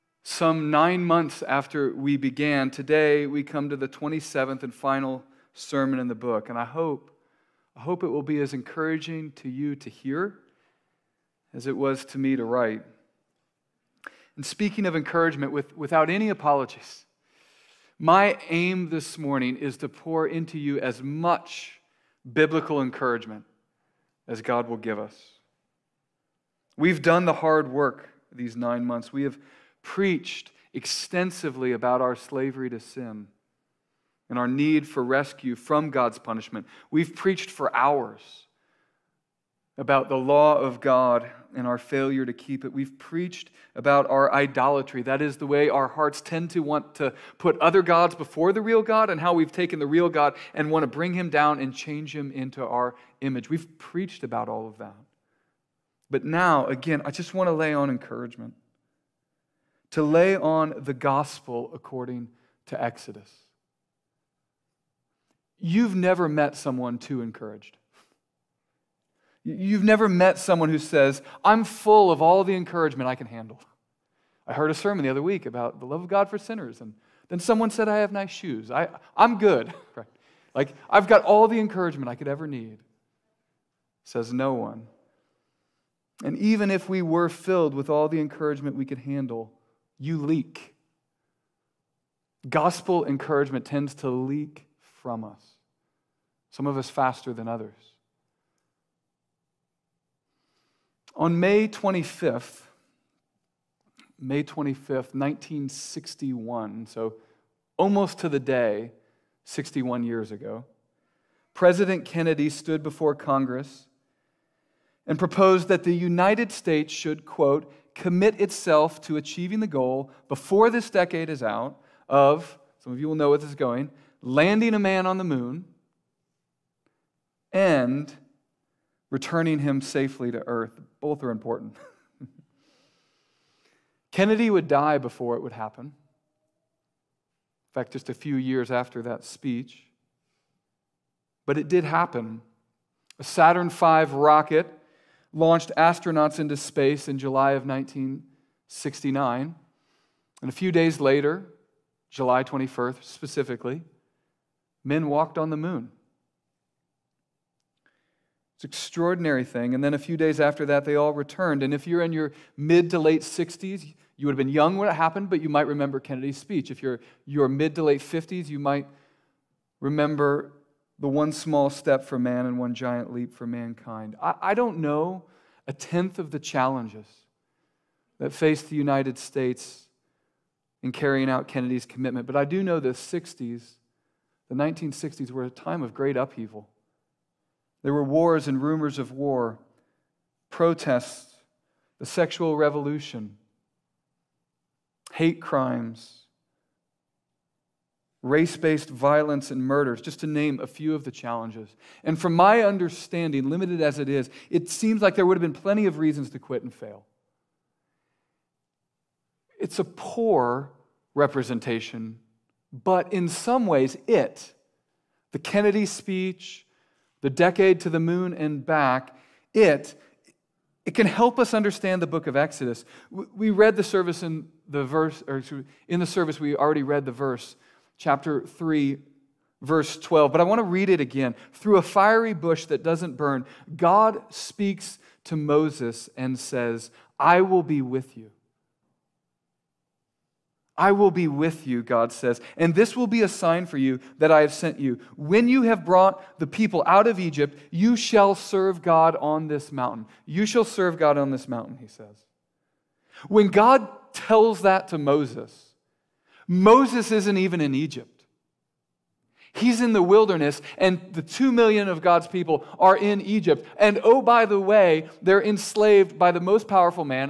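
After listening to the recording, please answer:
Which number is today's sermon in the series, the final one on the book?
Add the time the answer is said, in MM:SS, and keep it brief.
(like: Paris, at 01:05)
27th, at 00:03.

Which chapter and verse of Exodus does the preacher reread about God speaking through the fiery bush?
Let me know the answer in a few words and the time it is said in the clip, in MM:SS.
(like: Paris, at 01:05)
chapter 3, verse 12, at 03:48.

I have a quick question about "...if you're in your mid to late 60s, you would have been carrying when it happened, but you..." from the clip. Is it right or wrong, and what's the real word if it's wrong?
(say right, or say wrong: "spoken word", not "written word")
wrong: "young", not "carrying".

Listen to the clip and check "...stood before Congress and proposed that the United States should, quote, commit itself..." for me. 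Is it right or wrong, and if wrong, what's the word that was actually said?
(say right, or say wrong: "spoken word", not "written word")
right.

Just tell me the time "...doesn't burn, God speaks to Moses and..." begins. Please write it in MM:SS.
03:52.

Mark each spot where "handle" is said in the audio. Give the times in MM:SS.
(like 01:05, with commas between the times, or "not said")
01:13, 01:28.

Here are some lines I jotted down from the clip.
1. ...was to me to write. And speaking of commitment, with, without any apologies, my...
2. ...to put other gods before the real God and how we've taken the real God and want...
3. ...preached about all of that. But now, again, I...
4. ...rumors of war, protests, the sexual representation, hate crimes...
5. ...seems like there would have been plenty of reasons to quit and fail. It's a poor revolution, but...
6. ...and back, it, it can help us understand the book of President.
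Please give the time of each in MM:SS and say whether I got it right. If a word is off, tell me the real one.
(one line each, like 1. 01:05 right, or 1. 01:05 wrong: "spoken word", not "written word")
1. 00:11 wrong: "encouragement", not "commitment"
2. 00:46 right
3. 00:53 right
4. 03:08 wrong: "revolution", not "representation"
5. 03:24 wrong: "representation", not "revolution"
6. 03:38 wrong: "Exodus", not "President".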